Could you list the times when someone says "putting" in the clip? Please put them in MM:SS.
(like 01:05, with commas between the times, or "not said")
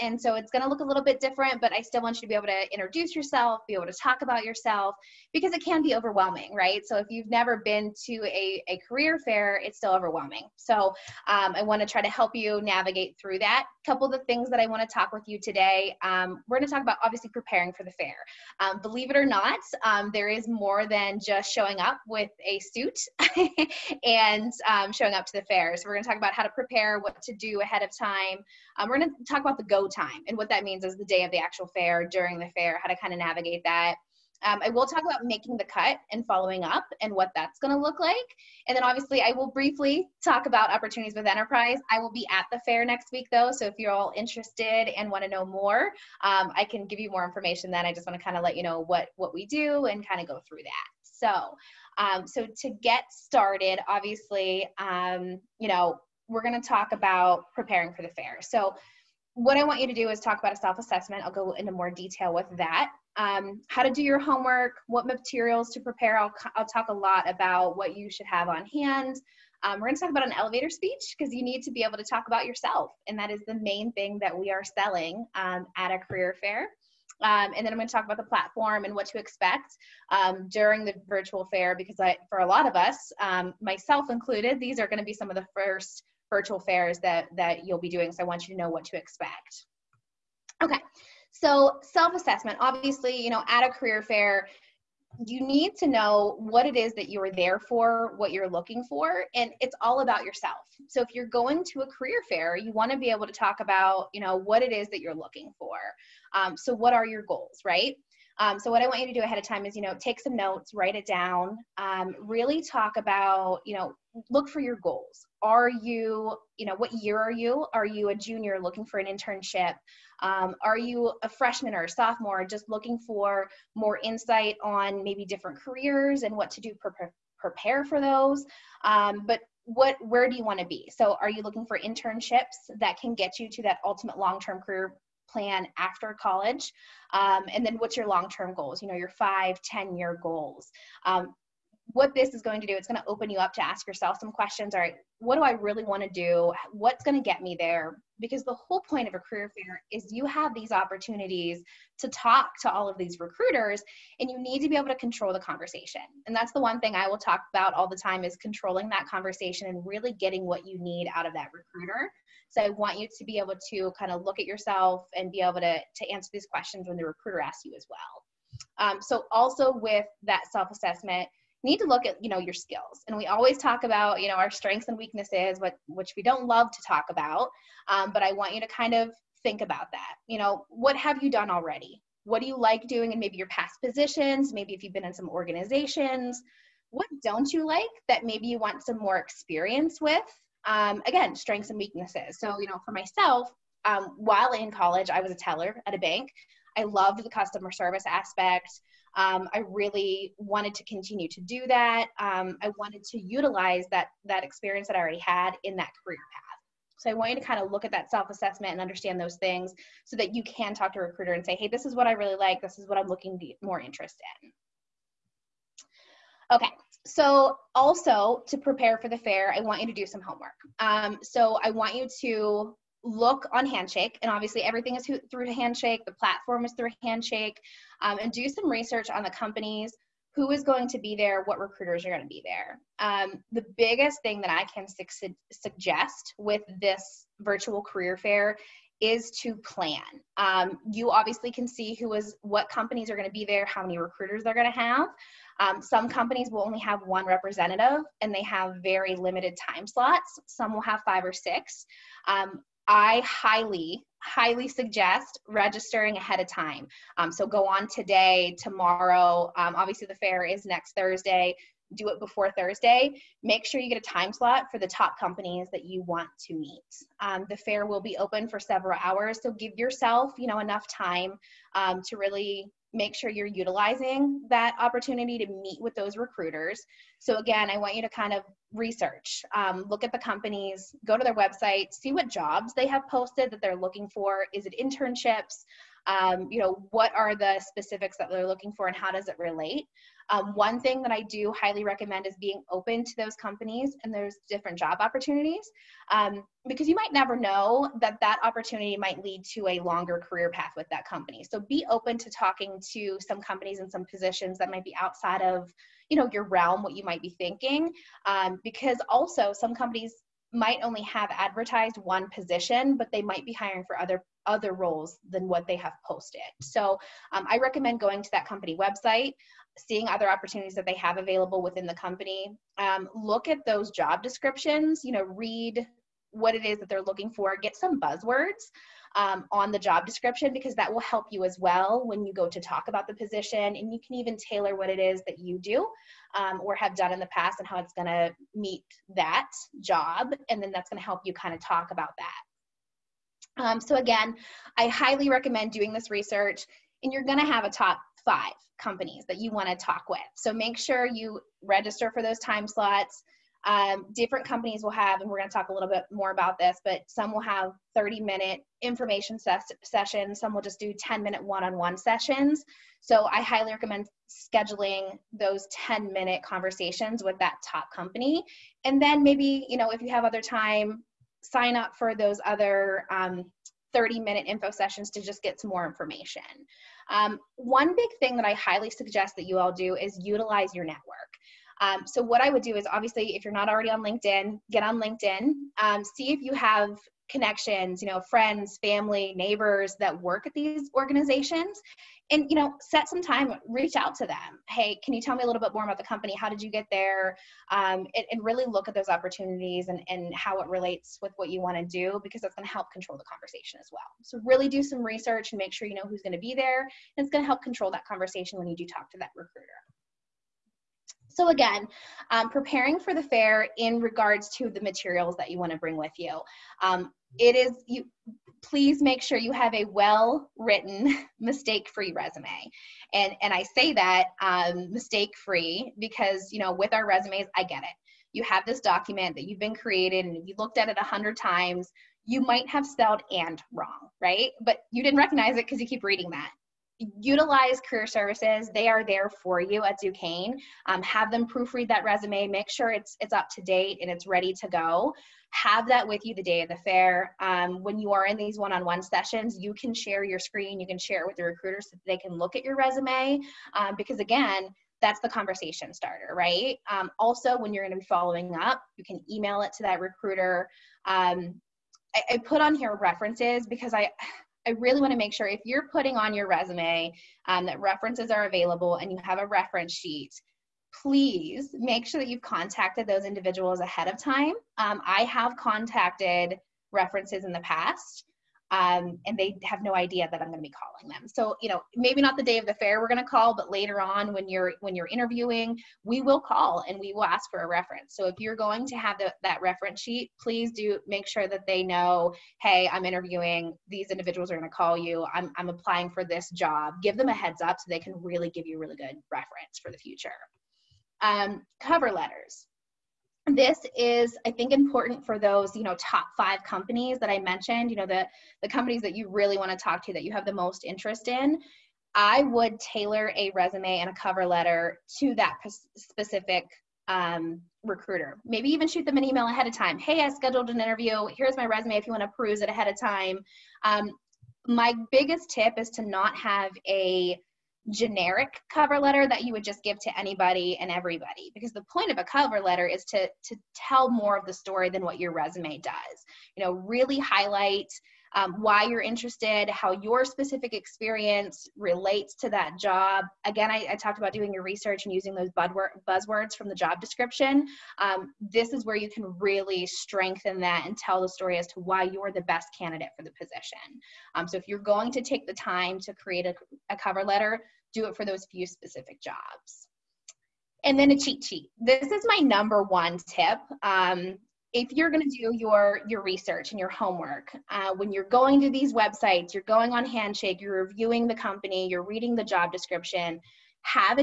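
07:45.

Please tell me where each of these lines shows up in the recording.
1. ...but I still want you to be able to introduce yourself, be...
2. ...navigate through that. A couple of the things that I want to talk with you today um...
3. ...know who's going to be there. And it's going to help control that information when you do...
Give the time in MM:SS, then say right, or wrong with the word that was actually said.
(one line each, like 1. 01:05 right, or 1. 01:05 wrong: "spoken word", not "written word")
1. 00:01 right
2. 00:12 right
3. 06:45 wrong: "conversation", not "information".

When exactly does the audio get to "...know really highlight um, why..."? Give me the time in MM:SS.
08:56.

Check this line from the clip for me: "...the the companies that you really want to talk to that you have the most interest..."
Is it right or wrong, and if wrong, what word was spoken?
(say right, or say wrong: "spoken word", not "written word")
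right.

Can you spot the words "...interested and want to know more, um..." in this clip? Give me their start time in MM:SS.
00:44.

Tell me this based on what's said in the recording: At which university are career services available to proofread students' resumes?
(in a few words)
Duquesne.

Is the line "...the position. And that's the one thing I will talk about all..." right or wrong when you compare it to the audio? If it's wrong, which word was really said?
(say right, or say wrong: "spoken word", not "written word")
wrong: "conversation", not "position".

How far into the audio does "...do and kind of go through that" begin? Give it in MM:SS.
00:49.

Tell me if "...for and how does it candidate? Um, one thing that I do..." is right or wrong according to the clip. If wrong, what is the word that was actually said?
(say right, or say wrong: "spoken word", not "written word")
wrong: "relate", not "candidate".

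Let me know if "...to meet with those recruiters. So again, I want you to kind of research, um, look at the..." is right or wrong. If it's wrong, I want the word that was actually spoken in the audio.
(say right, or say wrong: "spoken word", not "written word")
right.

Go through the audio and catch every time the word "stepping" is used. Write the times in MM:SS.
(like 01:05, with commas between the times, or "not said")
not said.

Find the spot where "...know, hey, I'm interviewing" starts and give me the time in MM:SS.
08:11.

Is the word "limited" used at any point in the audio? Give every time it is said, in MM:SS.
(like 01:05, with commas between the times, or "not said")
04:09.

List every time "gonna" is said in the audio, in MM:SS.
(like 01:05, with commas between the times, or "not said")
05:47, 05:55.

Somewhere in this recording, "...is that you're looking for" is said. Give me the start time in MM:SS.
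01:44.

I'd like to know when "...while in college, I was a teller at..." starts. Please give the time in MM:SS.
03:14.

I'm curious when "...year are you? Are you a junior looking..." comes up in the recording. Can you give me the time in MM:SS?
01:56.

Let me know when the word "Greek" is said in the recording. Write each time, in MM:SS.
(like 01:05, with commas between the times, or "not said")
not said.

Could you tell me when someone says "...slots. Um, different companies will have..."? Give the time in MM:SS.
05:52.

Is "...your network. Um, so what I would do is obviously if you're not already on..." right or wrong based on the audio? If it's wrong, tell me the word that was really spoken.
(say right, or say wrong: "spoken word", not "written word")
right.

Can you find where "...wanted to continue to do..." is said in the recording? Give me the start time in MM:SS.
03:20.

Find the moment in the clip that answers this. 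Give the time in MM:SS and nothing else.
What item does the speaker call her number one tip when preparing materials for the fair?
09:21.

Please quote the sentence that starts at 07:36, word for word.
Um, also, when you're going to be following up, you can email it to that recruiter.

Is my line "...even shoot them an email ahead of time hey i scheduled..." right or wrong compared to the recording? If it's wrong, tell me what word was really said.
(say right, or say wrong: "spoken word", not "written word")
right.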